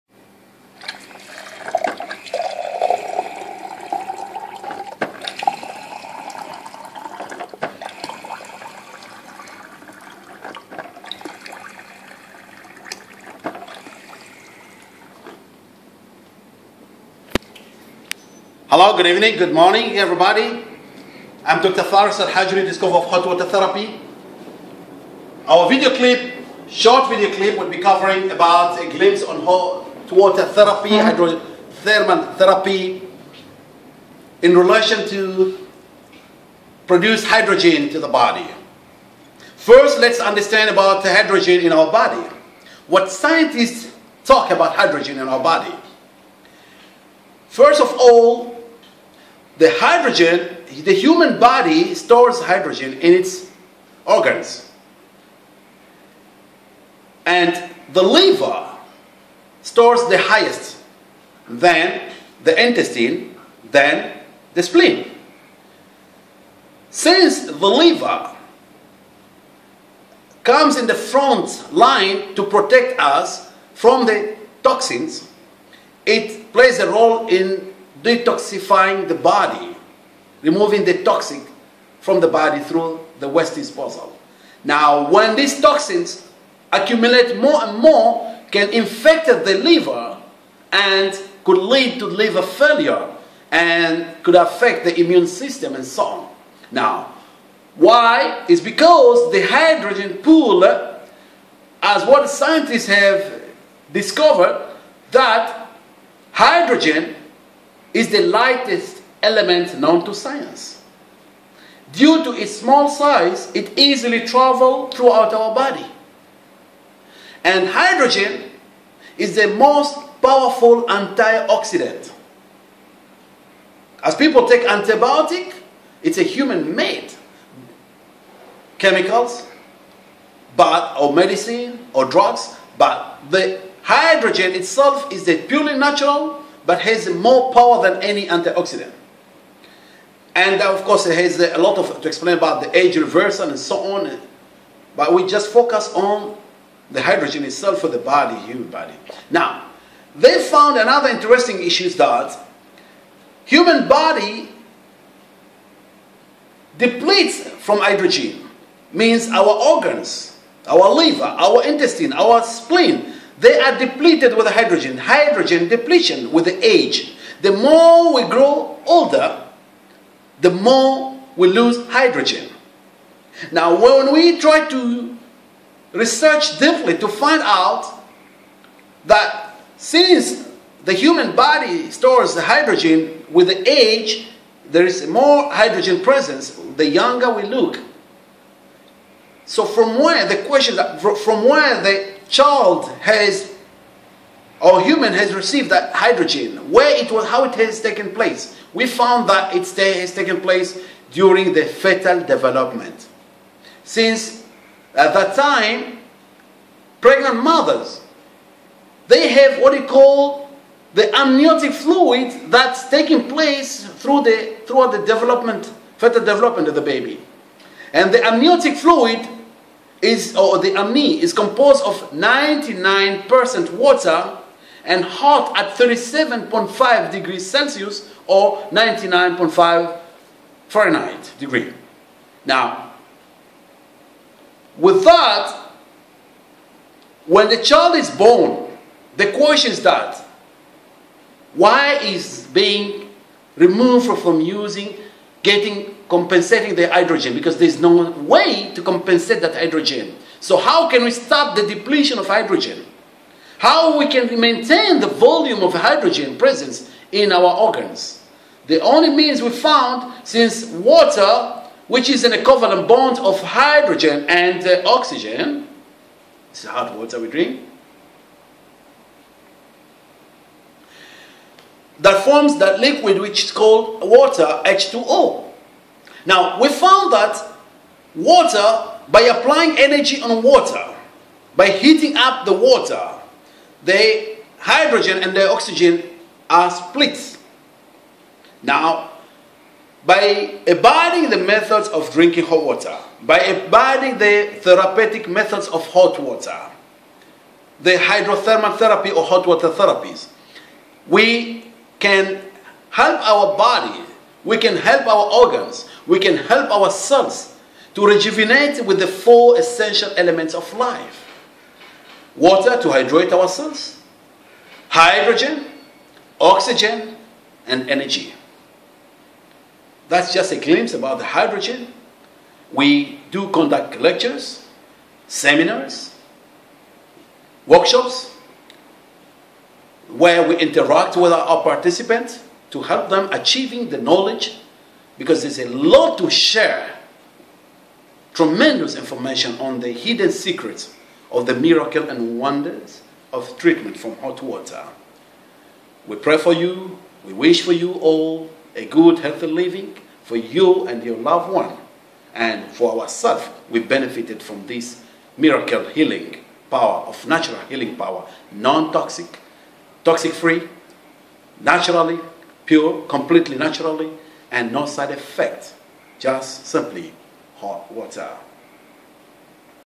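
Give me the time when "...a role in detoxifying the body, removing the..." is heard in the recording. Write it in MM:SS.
01:16.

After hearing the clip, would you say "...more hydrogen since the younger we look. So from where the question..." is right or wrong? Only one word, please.
wrong.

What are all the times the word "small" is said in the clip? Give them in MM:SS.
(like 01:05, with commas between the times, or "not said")
01:52.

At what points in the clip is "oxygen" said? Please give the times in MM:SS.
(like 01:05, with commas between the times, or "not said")
04:24, 04:45, 05:16.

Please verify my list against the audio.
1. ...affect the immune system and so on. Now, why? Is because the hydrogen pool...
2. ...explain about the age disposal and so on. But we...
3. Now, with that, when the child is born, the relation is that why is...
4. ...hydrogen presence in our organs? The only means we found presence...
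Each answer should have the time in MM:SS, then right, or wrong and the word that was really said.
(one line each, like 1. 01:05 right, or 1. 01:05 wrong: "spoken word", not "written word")
1. 01:34 right
2. 02:22 wrong: "reversal", not "disposal"
3. 03:52 wrong: "question", not "relation"
4. 04:15 wrong: "since", not "presence".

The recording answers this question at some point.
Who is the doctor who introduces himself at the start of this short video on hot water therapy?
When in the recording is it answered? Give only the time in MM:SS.
00:21.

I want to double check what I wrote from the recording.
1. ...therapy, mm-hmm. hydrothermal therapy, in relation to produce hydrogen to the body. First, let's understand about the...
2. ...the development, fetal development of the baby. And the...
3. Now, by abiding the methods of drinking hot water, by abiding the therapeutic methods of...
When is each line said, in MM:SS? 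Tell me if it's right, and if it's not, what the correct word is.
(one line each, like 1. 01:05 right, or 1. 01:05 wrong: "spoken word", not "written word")
1. 00:30 right
2. 03:34 right
3. 04:48 right.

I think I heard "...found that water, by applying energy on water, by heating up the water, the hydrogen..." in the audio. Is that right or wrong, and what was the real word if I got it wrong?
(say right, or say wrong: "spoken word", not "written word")
right.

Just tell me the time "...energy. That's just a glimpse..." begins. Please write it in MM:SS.
05:17.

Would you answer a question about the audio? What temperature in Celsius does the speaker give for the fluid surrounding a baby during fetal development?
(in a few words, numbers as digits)
37.5 degrees Celsius.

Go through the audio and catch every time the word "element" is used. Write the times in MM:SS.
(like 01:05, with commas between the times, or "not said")
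01:49, 05:10.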